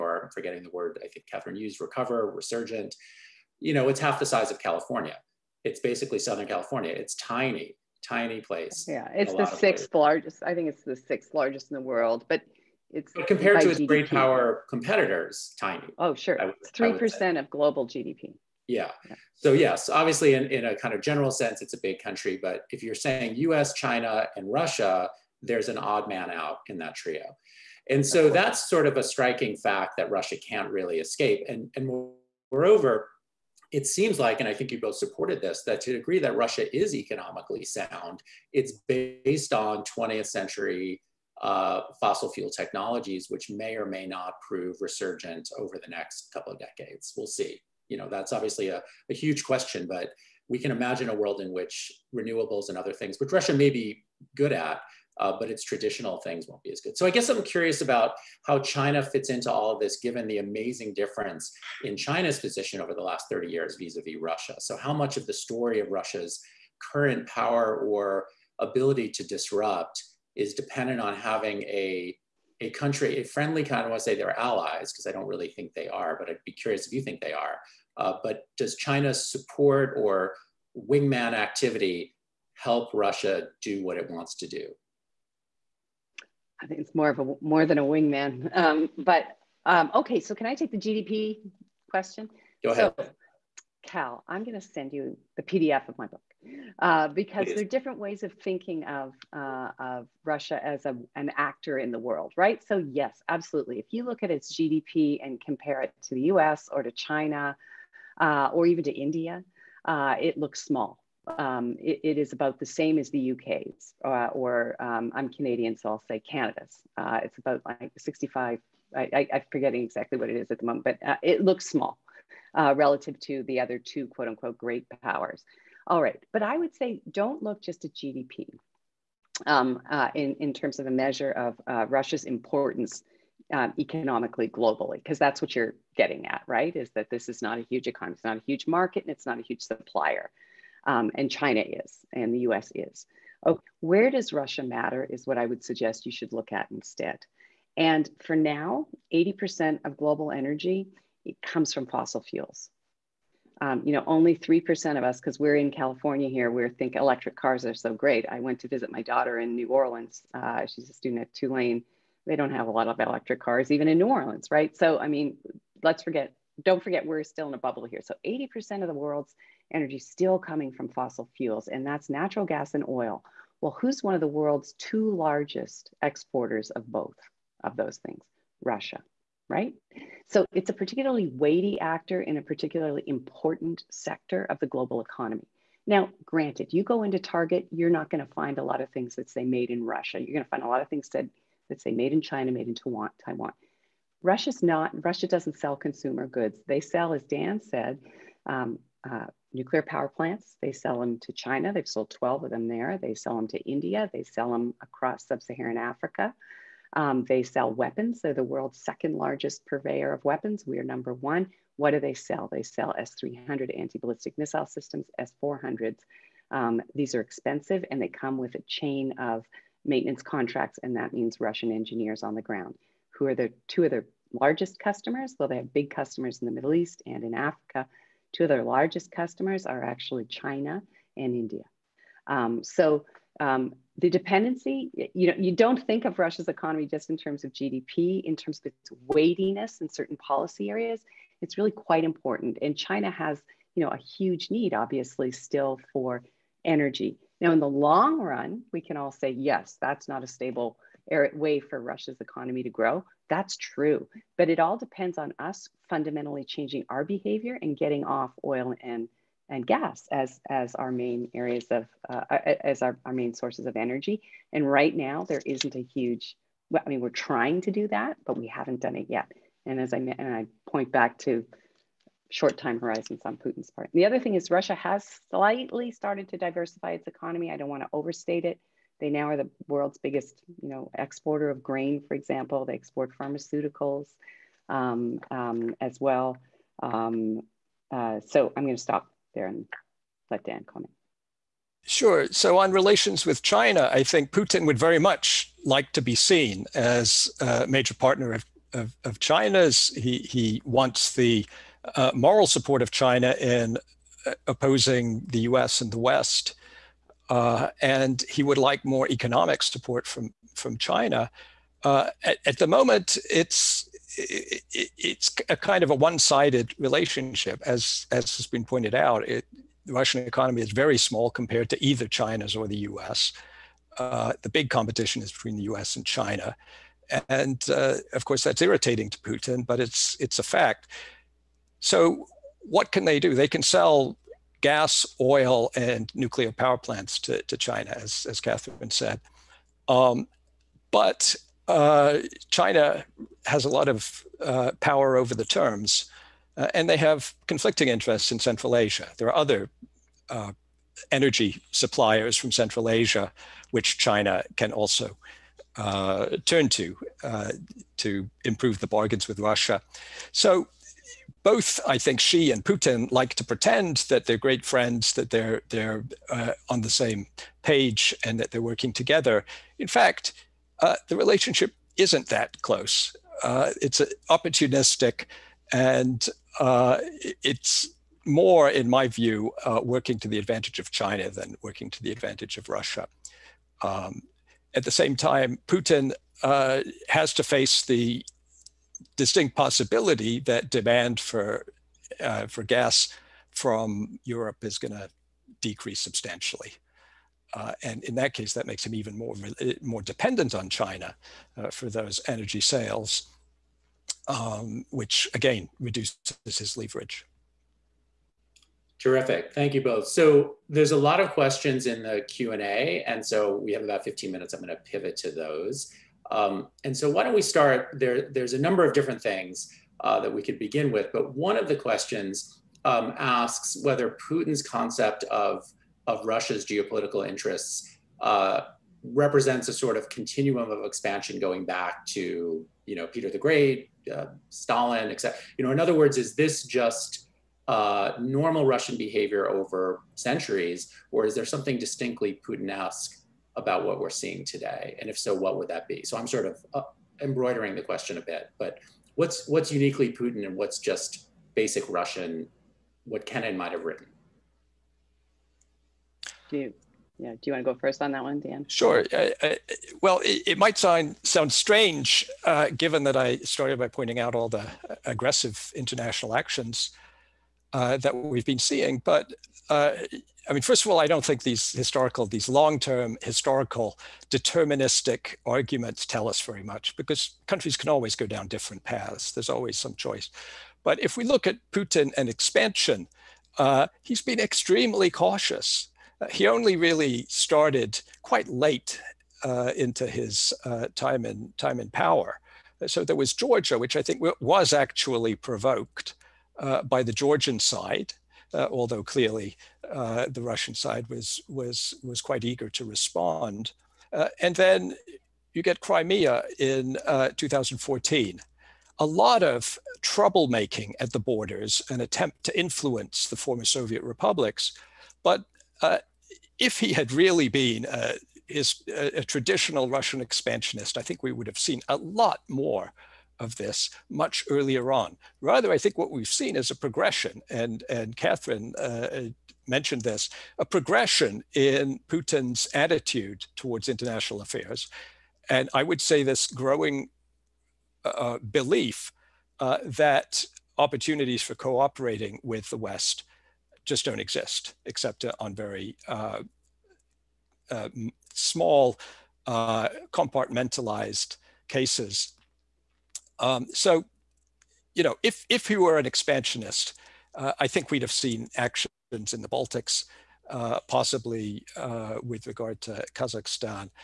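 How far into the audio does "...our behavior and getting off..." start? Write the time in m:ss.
4:16.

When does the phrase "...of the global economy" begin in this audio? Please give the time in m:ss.
3:04.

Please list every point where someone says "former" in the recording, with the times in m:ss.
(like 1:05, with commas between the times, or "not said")
8:33.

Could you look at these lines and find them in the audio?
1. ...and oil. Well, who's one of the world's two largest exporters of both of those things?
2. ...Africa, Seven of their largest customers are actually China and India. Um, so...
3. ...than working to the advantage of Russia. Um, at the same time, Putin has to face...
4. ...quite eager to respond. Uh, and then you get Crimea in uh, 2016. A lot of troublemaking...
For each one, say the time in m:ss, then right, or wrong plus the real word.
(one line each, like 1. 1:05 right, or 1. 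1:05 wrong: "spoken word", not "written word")
1. 2:52 right
2. 3:47 wrong: "Two", not "Seven"
3. 6:21 right
4. 8:22 wrong: "2014", not "2016".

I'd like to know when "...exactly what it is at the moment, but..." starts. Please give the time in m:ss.
1:59.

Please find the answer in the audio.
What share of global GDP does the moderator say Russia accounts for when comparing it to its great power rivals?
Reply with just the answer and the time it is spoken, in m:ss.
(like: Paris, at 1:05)
3%, at 0:16.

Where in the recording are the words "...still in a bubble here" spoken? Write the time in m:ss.
2:47.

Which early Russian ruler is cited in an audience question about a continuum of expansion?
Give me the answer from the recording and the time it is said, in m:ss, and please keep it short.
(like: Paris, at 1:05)
Peter the Great, at 7:13.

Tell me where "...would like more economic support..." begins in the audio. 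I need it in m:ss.
5:08.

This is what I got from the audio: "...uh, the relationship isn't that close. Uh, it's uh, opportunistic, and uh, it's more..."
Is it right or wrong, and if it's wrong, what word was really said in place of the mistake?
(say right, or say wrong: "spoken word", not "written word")
right.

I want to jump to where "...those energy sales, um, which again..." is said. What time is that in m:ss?
6:41.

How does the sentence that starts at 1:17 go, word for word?
Uh, but does China's support or wingman activity help Russia do what it wants to do?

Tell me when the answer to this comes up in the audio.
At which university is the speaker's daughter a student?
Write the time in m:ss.
2:41.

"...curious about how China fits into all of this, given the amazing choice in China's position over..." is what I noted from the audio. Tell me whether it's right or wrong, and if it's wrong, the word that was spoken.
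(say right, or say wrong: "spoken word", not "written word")
wrong: "difference", not "choice".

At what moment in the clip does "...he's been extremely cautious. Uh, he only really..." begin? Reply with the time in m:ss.
8:04.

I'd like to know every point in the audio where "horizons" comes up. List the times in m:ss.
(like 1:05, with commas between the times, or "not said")
4:32.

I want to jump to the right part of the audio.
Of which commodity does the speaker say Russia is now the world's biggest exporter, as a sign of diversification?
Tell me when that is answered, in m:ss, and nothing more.
4:41.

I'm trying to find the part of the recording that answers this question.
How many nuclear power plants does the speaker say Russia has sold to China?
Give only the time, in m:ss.
3:22.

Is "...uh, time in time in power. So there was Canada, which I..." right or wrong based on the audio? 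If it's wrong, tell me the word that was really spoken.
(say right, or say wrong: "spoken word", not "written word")
wrong: "Georgia", not "Canada".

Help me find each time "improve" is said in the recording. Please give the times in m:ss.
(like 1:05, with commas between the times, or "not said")
5:58.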